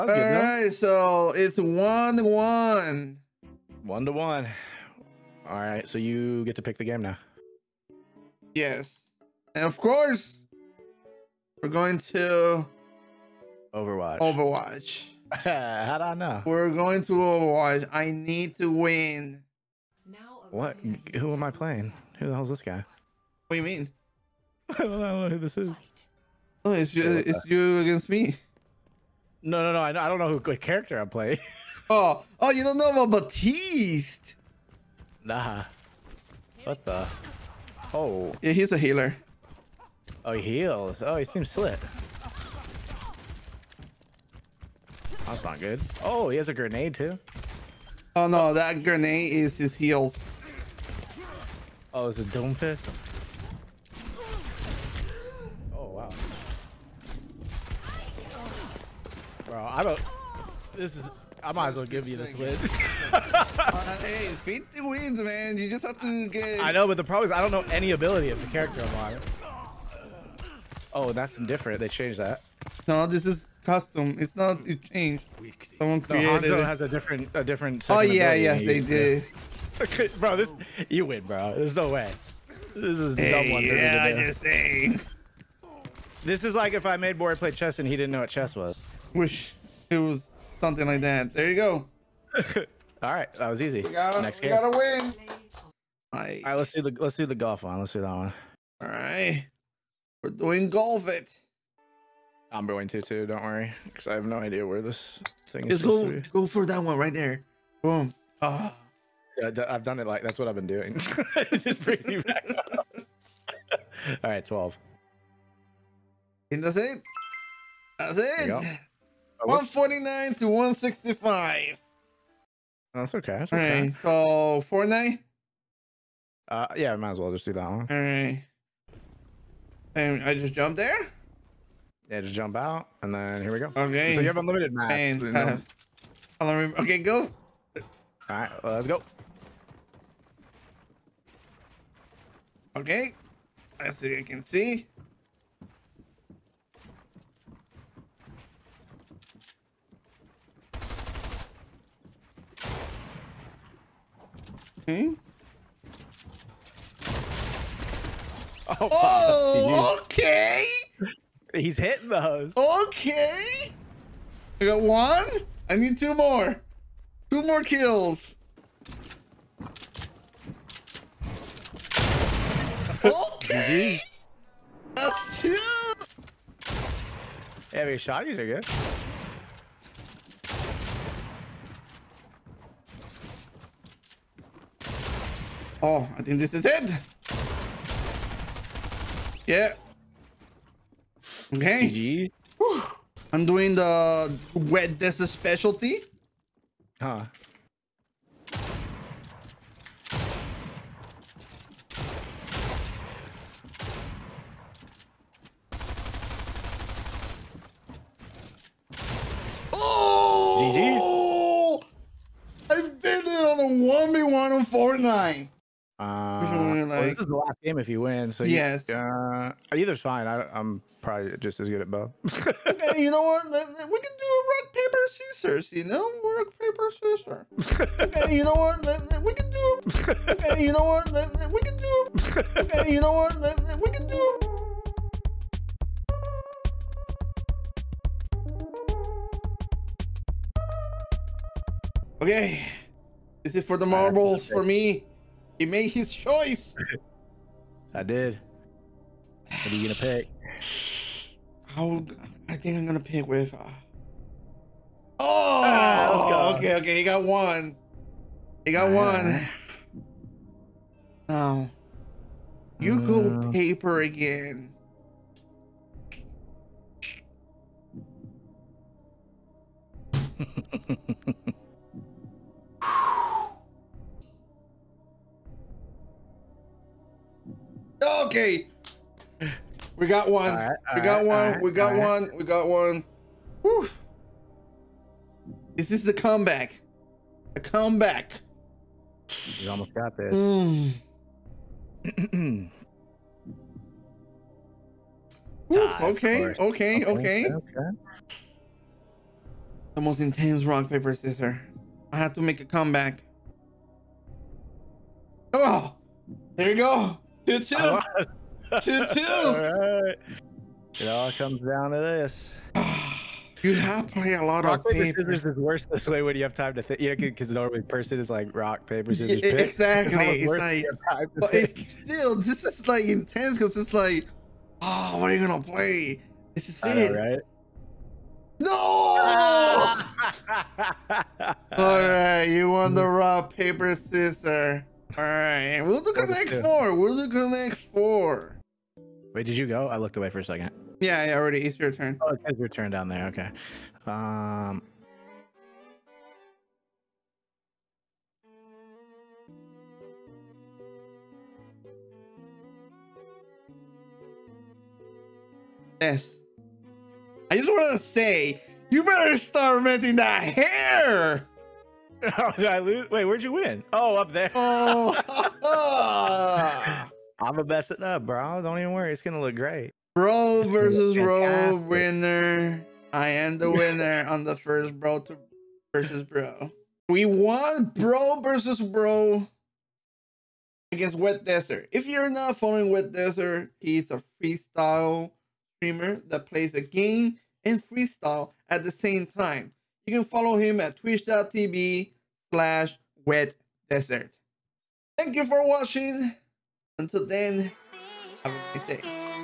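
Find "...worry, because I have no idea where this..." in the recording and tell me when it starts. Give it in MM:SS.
01:43.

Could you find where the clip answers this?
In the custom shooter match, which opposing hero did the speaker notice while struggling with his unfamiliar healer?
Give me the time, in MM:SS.
00:52.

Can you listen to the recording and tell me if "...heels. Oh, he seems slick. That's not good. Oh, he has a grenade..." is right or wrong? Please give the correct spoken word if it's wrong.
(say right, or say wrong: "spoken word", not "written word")
wrong: "heals", not "heels".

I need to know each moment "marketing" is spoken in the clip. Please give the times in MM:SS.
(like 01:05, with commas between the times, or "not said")
not said.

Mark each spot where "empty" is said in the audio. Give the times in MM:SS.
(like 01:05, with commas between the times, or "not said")
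not said.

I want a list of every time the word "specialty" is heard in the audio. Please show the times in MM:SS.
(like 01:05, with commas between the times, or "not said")
03:15.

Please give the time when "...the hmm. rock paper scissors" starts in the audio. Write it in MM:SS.
05:32.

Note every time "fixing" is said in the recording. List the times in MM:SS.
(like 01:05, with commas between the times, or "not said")
not said.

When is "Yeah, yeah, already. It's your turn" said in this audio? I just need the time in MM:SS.
05:41.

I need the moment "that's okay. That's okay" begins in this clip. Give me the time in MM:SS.
02:02.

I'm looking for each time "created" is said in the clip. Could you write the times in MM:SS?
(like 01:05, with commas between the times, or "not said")
01:16.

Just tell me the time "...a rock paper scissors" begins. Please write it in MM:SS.
03:44.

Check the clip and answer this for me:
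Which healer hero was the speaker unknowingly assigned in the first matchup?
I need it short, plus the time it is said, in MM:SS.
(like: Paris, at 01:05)
Baptiste, at 00:33.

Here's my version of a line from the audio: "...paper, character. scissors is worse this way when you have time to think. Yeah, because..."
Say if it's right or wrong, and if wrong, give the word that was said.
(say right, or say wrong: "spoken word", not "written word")
wrong: "paper", not "character".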